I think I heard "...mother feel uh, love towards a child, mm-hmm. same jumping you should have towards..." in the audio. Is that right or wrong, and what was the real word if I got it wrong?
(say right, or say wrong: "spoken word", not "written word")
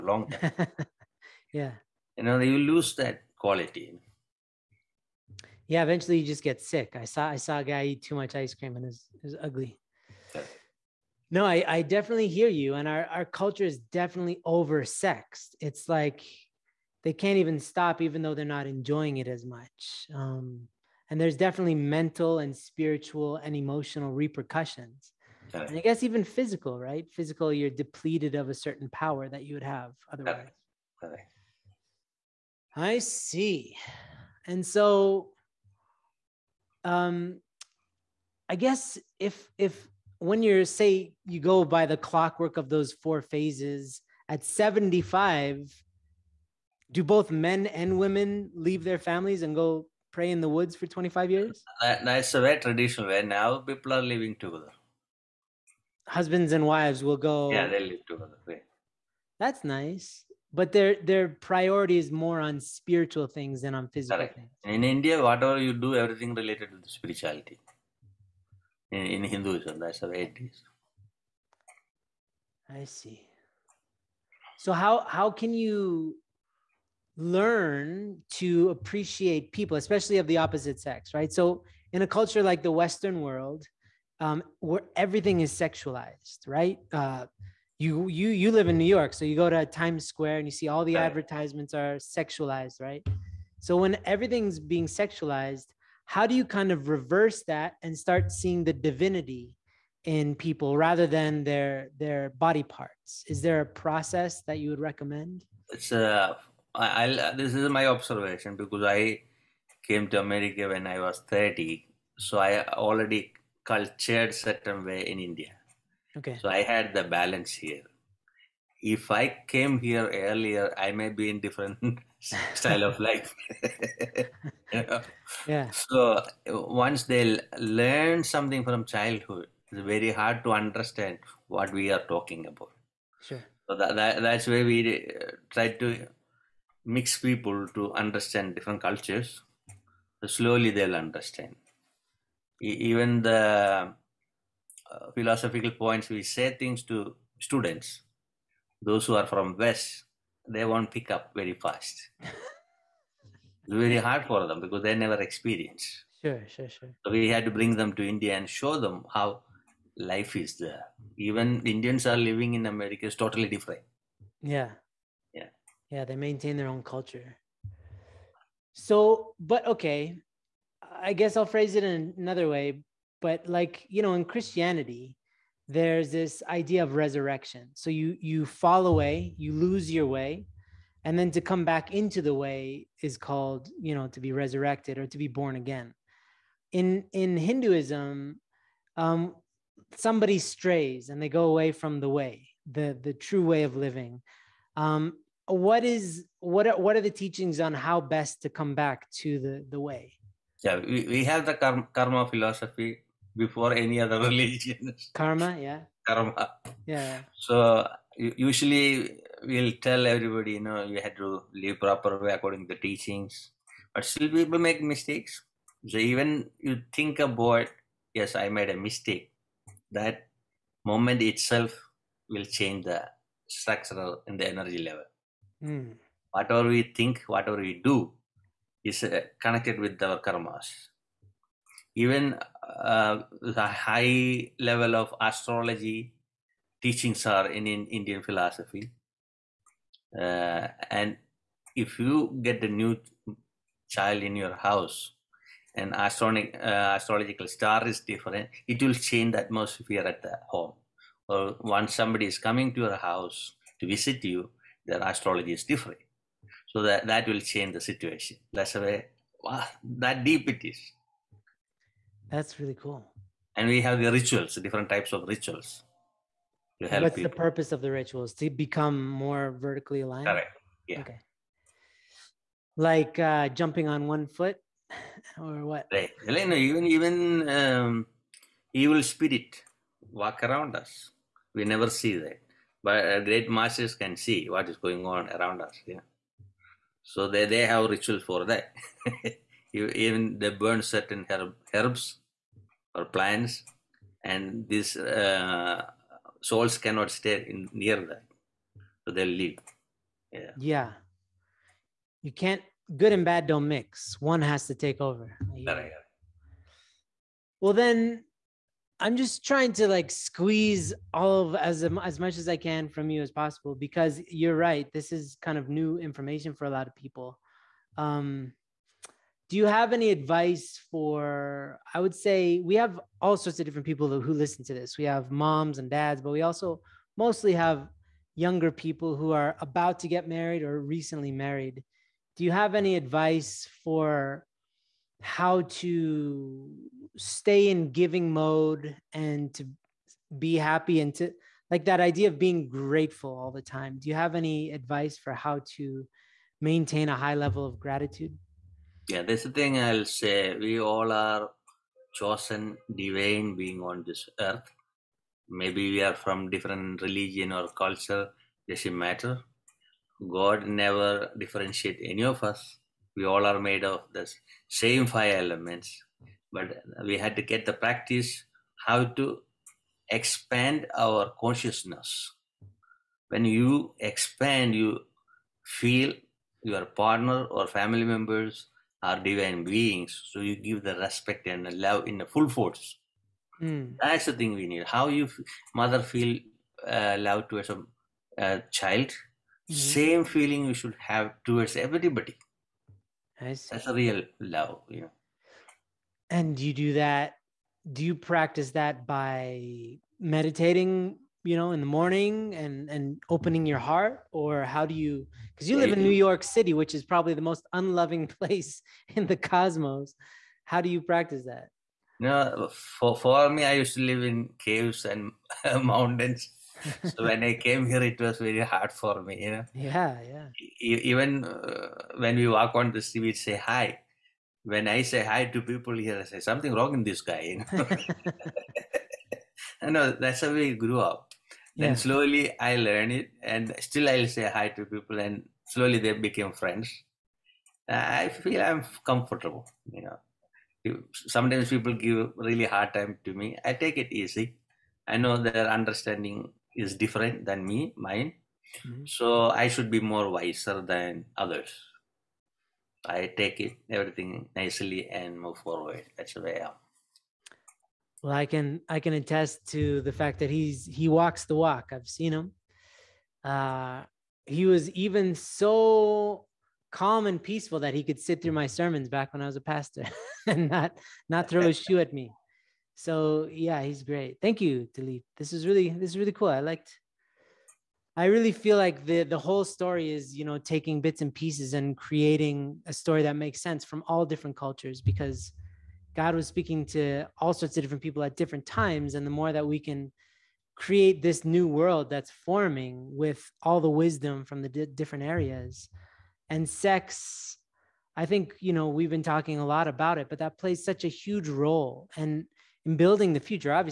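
wrong: "feeling", not "jumping".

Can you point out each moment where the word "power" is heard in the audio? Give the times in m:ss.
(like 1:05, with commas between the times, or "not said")
0:28.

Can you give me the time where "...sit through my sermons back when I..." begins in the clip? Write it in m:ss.
7:48.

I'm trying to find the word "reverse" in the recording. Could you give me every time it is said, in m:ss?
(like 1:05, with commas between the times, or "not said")
1:36.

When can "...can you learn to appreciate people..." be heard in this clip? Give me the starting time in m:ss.
1:15.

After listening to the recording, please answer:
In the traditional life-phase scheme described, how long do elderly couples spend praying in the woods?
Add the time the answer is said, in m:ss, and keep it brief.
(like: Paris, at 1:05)
25 years, at 0:50.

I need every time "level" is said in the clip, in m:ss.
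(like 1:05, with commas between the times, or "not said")
3:44, 3:54, 5:47.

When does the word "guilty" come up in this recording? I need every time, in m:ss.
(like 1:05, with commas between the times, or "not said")
not said.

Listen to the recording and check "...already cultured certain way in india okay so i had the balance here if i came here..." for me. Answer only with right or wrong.
right.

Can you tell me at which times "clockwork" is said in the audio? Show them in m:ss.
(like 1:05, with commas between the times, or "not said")
0:42.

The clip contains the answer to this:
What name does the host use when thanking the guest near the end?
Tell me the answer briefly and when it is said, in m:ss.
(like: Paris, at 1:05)
Talib, at 7:54.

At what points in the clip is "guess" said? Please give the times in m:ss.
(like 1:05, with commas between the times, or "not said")
0:25, 0:38, 2:51.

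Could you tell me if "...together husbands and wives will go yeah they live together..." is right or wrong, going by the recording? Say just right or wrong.
right.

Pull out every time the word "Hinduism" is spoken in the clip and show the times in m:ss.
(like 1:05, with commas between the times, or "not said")
1:09, 3:07.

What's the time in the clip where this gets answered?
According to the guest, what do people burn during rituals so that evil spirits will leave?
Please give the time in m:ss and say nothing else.
4:51.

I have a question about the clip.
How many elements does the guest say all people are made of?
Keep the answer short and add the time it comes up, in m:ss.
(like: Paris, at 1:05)
5, at 6:05.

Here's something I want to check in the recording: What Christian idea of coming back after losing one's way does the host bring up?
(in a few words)
Resurrection.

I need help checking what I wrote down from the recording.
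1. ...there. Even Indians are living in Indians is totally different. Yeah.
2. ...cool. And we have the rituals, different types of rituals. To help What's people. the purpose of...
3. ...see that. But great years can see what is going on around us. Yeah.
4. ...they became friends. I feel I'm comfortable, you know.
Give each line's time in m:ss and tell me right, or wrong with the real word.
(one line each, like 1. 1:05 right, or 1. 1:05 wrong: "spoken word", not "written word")
1. 2:40 wrong: "America", not "Indians"
2. 4:22 right
3. 4:41 wrong: "masters", not "years"
4. 7:15 right.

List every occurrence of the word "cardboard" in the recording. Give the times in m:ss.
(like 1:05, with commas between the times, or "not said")
not said.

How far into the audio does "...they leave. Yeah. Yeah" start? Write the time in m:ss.
4:59.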